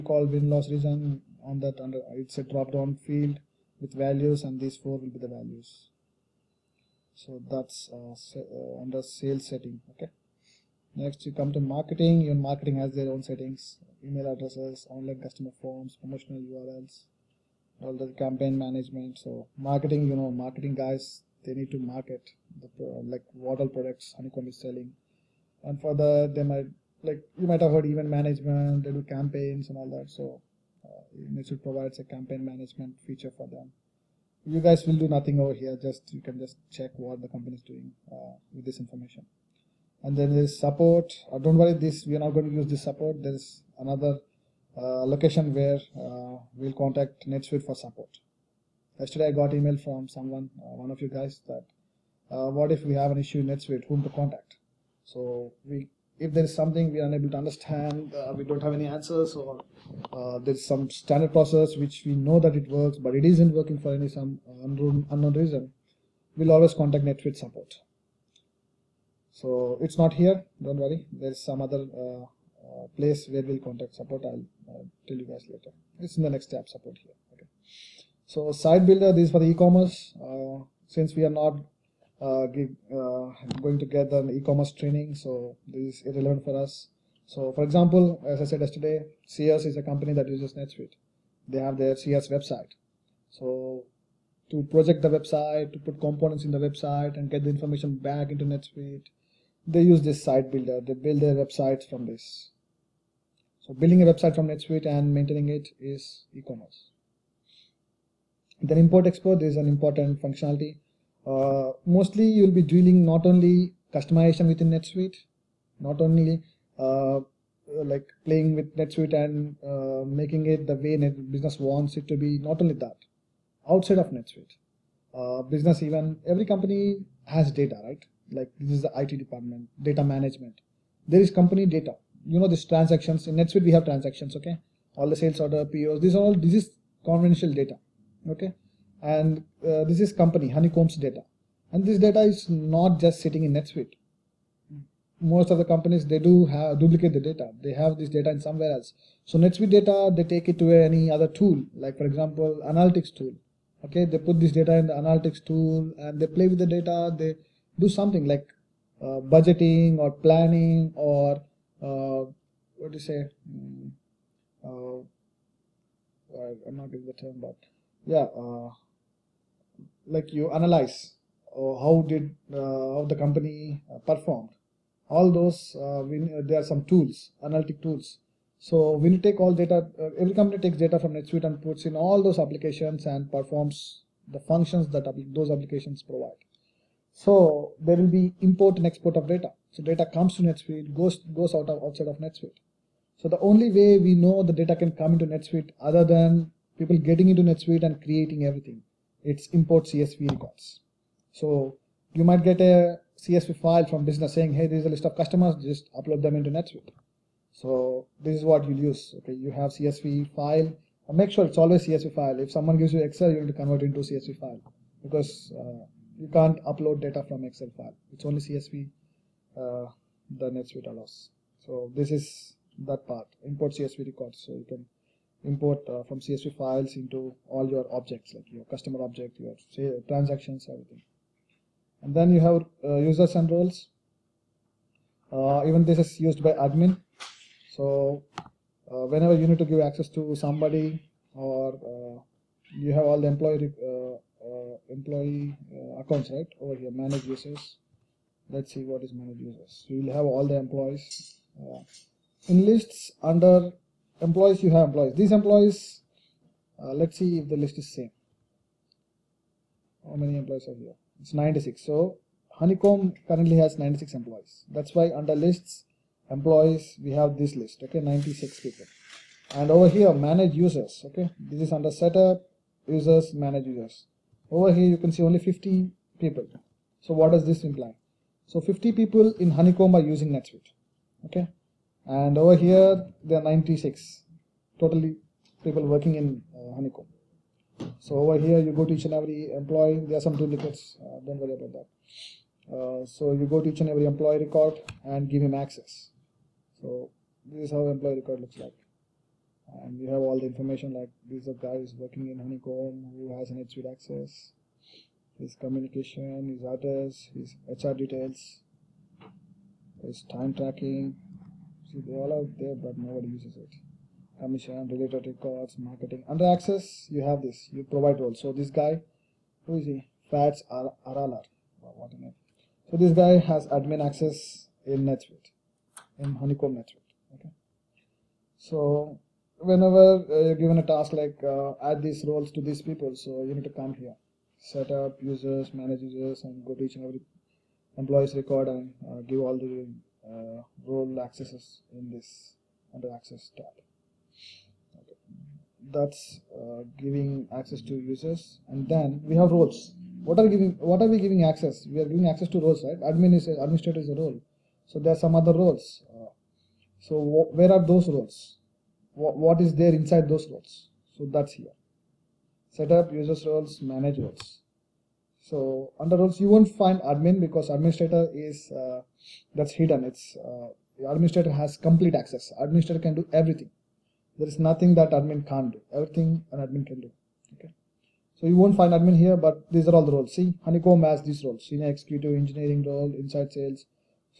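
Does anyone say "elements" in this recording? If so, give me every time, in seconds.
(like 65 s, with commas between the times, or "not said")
not said.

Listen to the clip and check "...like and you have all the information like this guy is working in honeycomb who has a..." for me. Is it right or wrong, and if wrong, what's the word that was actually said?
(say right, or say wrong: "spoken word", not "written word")
right.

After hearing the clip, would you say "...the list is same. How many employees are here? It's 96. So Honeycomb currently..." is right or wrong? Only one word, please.
right.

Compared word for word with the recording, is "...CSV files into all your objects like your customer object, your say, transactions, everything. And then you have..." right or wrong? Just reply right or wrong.
right.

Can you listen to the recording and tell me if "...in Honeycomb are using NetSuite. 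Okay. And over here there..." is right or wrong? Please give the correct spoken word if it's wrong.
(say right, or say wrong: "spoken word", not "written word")
right.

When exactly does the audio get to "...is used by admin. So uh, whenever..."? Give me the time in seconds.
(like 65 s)
235 s.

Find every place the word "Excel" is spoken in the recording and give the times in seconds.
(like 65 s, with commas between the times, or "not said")
213 s, 217 s.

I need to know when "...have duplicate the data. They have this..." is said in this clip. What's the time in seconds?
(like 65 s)
146 s.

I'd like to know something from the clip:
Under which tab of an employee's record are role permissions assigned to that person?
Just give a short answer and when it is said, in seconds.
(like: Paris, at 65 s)
Access tab, at 343 s.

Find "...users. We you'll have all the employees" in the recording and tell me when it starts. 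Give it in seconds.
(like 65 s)
249 s.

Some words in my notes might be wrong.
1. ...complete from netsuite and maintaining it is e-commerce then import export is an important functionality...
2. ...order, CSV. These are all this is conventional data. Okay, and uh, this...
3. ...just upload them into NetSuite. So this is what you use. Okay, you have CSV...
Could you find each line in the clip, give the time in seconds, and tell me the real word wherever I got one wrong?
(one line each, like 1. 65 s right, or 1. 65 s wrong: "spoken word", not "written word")
1. 104 s wrong: "website", not "complete"
2. 135 s wrong: "POs", not "CSV"
3. 205 s right.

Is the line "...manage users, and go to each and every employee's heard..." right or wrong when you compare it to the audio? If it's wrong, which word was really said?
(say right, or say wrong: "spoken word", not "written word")
wrong: "record", not "heard".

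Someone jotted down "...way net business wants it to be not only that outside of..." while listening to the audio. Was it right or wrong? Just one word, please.
right.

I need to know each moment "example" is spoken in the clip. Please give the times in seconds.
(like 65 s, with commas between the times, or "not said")
87 s, 152 s.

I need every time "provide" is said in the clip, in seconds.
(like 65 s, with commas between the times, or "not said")
31 s, 186 s, 317 s.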